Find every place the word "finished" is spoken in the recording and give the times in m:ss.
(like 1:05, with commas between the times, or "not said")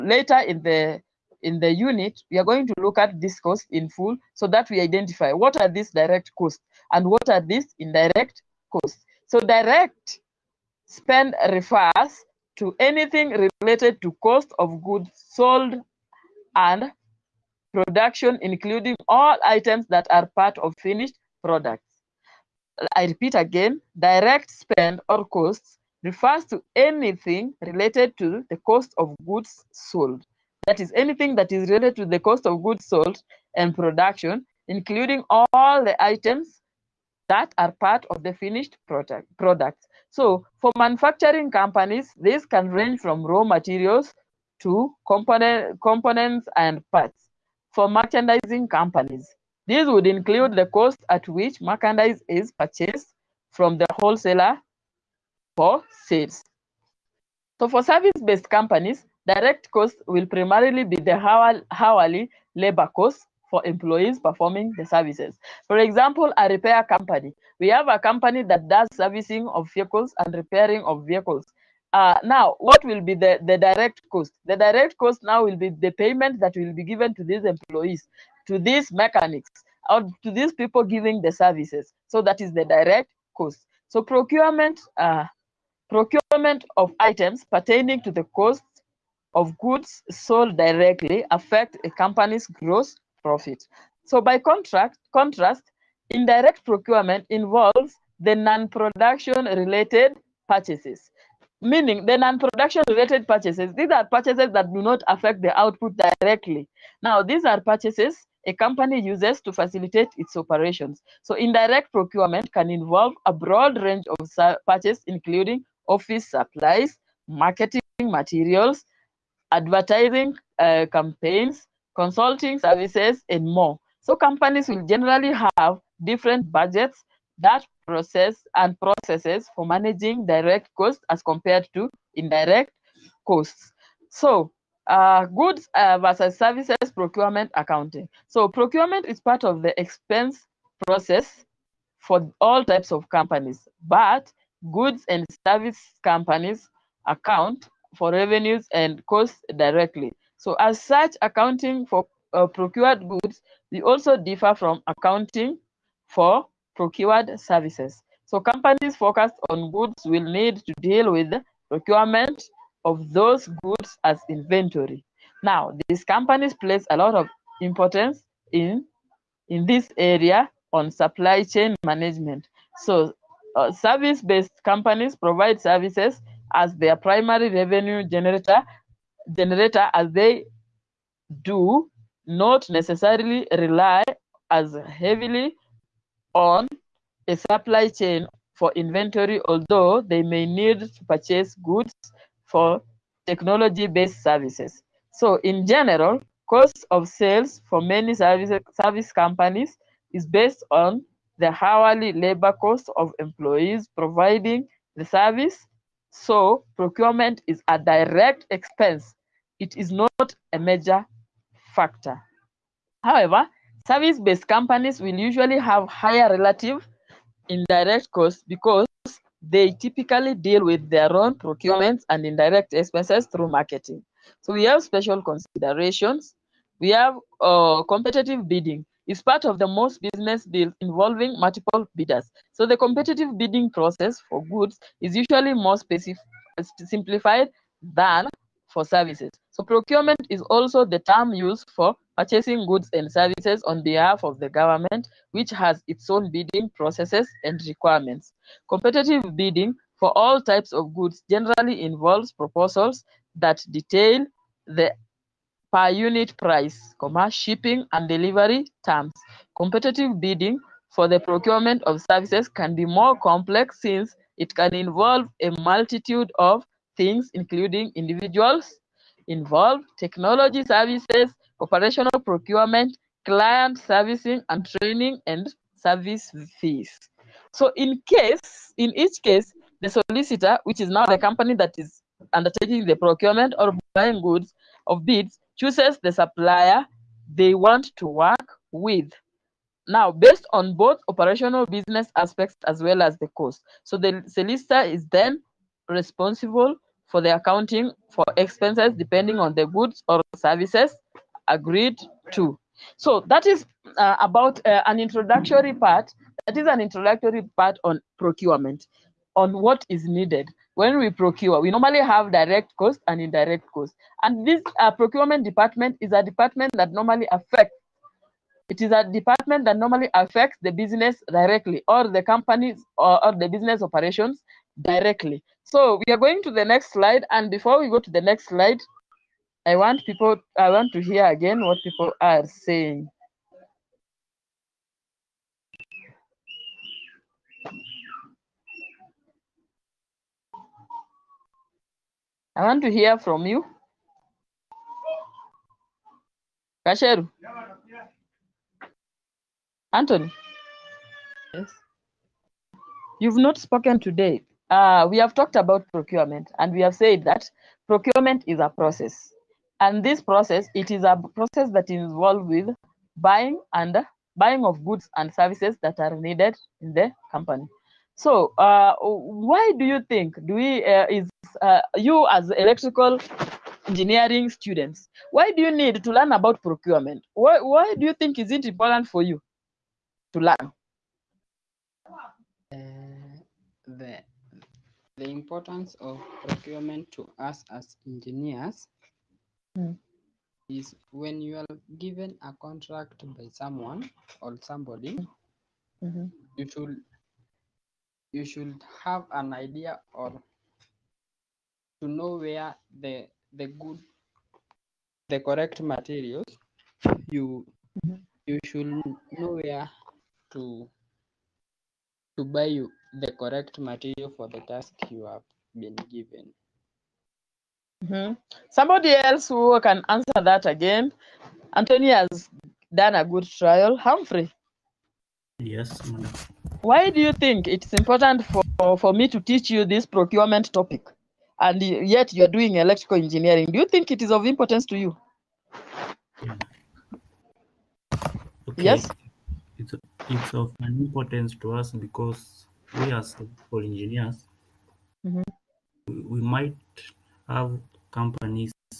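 0:20, 0:38.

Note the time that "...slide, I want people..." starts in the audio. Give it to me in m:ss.
5:28.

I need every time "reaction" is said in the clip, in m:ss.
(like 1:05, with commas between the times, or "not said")
not said.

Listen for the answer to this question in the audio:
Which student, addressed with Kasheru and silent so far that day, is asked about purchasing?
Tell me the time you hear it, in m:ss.
5:49.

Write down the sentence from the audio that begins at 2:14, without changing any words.
So uh, goods uh, versus services procurement accounting.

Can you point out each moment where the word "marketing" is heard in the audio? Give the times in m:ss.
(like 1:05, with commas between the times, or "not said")
1:57, 3:43.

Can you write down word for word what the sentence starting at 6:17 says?
Why why do you think is it important for you to learn?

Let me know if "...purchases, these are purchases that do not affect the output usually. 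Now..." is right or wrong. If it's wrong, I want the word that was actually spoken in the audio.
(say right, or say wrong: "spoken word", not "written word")
wrong: "directly", not "usually".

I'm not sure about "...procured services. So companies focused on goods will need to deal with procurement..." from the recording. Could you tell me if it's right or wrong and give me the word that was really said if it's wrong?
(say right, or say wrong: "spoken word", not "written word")
right.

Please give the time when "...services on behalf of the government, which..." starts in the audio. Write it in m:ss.
4:03.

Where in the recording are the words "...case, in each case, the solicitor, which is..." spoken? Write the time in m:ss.
4:38.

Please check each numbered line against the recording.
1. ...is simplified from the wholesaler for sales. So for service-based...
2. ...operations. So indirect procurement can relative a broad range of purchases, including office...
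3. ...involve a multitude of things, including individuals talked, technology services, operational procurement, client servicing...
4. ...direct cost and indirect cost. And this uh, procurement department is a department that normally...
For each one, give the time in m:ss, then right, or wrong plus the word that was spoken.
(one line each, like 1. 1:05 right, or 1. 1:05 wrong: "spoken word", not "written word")
1. 0:52 wrong: "purchased", not "simplified"
2. 1:50 wrong: "involve", not "relative"
3. 4:24 wrong: "involved", not "talked"
4. 5:12 right.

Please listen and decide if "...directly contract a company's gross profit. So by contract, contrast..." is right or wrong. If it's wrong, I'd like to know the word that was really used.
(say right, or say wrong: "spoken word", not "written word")
wrong: "affect", not "contract".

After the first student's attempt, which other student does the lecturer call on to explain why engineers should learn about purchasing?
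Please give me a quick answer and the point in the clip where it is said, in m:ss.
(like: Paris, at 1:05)
Humphrey, at 7:03.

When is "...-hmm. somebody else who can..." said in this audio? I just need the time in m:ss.
6:58.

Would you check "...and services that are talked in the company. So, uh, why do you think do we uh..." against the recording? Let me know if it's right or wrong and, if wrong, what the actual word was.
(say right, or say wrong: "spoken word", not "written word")
wrong: "needed", not "talked".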